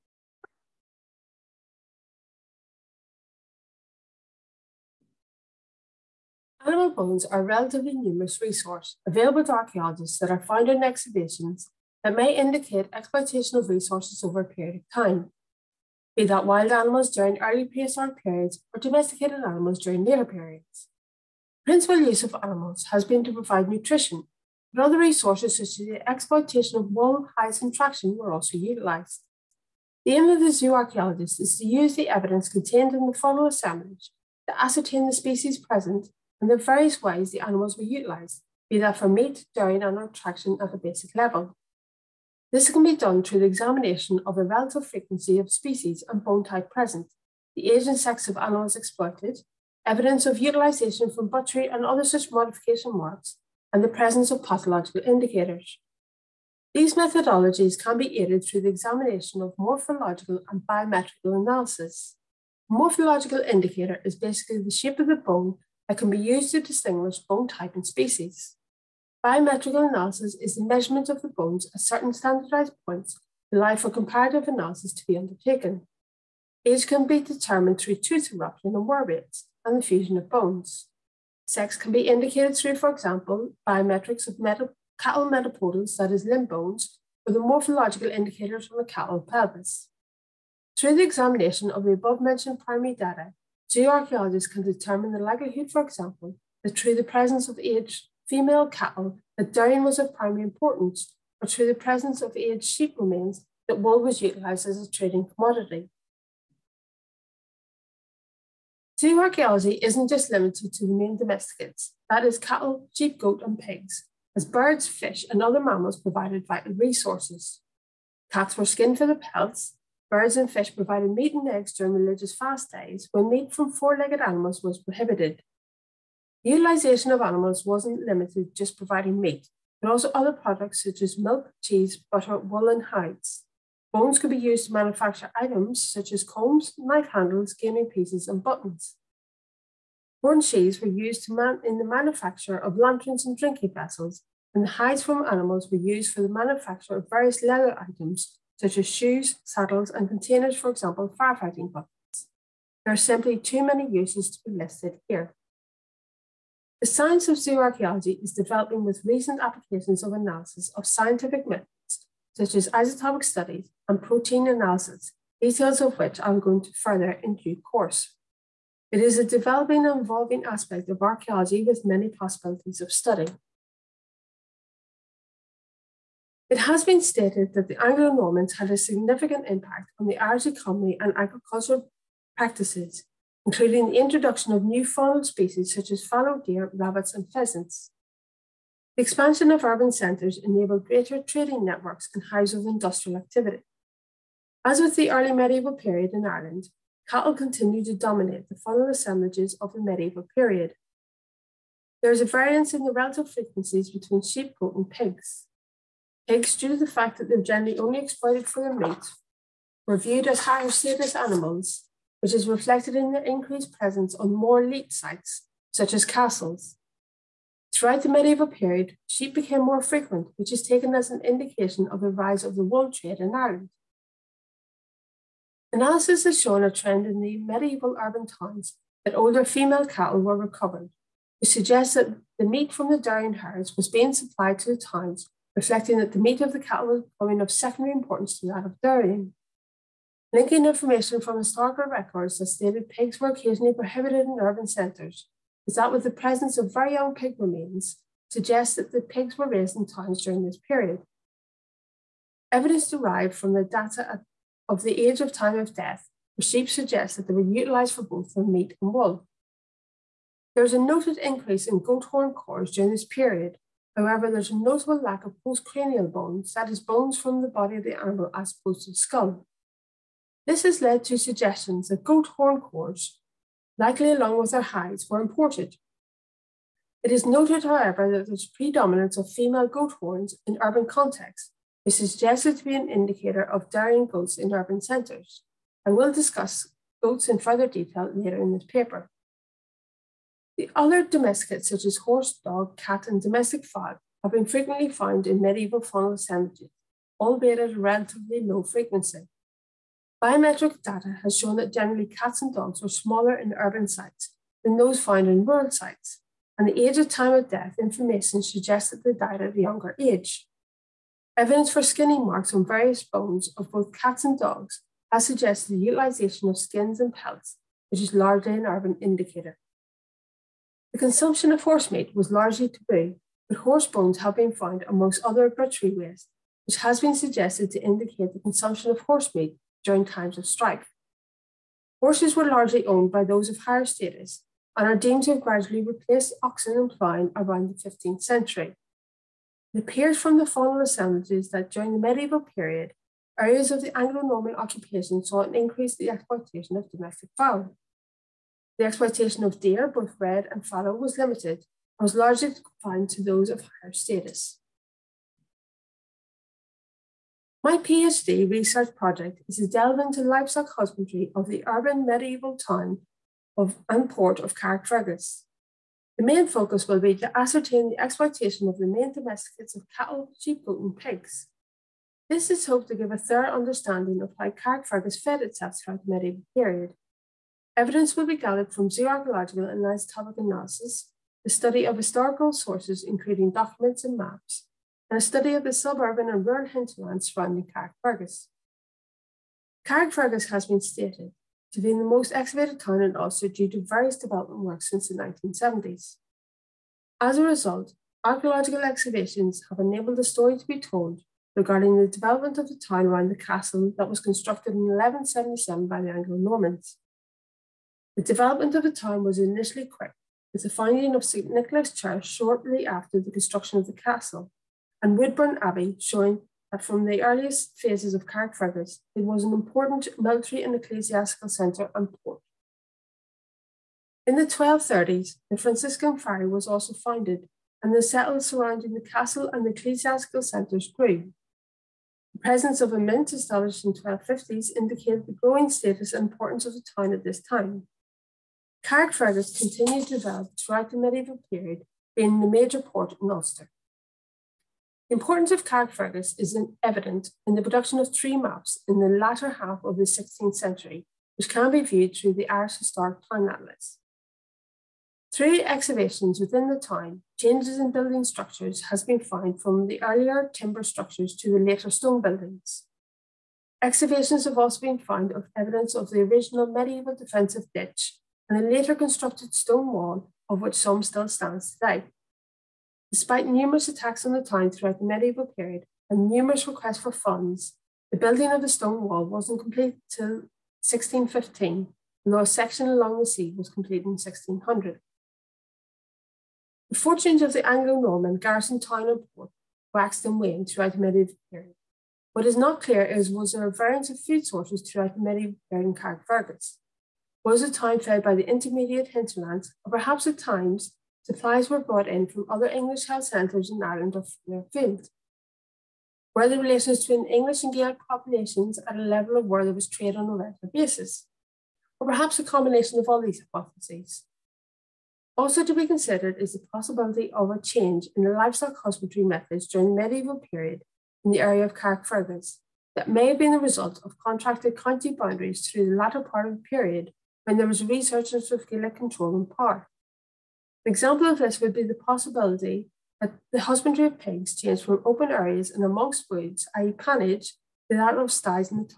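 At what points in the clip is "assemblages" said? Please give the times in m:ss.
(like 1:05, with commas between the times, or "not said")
0:33, 3:18, 5:40.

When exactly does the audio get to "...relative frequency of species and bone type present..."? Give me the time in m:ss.
0:44.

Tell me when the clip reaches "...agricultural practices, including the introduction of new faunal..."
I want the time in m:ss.
3:01.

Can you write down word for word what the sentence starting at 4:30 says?
This has led to suggestions that goat horn cores, likely along with their hides, were imported.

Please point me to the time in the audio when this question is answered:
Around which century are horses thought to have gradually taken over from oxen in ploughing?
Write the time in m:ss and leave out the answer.
5:37.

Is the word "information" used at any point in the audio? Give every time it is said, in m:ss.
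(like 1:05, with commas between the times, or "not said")
4:00, 5:07.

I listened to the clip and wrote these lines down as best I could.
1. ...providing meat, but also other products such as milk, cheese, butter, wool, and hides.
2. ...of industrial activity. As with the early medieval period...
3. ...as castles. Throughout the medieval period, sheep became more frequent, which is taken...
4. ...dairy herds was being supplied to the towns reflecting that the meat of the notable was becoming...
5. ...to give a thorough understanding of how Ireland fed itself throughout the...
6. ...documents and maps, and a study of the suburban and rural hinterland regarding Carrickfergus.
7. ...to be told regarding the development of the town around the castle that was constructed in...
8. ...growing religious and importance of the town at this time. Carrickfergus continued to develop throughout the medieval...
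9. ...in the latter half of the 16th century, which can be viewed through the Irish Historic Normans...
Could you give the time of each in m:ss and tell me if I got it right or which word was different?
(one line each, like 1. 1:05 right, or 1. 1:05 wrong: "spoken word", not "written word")
1. 2:08 right
2. 3:12 right
3. 3:35 right
4. 3:52 wrong: "cattle", not "notable"
5. 6:12 wrong: "Carrickfergus", not "Ireland"
6. 6:23 wrong: "surrounding", not "regarding"
7. 6:40 right
8. 7:15 wrong: "status", not "religious"
9. 7:28 wrong: "Town", not "Normans".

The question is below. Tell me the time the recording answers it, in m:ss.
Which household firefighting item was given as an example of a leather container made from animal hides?
2:31.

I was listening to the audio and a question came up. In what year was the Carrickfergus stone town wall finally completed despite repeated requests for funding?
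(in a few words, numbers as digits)
1615.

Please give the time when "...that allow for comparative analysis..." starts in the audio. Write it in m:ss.
1:13.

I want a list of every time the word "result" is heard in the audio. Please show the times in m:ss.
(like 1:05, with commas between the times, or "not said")
6:37, 8:43.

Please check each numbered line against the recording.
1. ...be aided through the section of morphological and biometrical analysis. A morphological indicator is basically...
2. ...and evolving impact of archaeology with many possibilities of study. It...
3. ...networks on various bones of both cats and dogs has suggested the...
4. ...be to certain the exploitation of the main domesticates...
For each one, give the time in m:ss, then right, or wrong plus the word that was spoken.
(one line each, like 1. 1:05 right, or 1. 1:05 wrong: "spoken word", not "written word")
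1. 0:57 wrong: "examination", not "section"
2. 2:49 wrong: "aspect", not "impact"
3. 5:12 wrong: "marks", not "networks"
4. 6:07 wrong: "ascertain", not "certain".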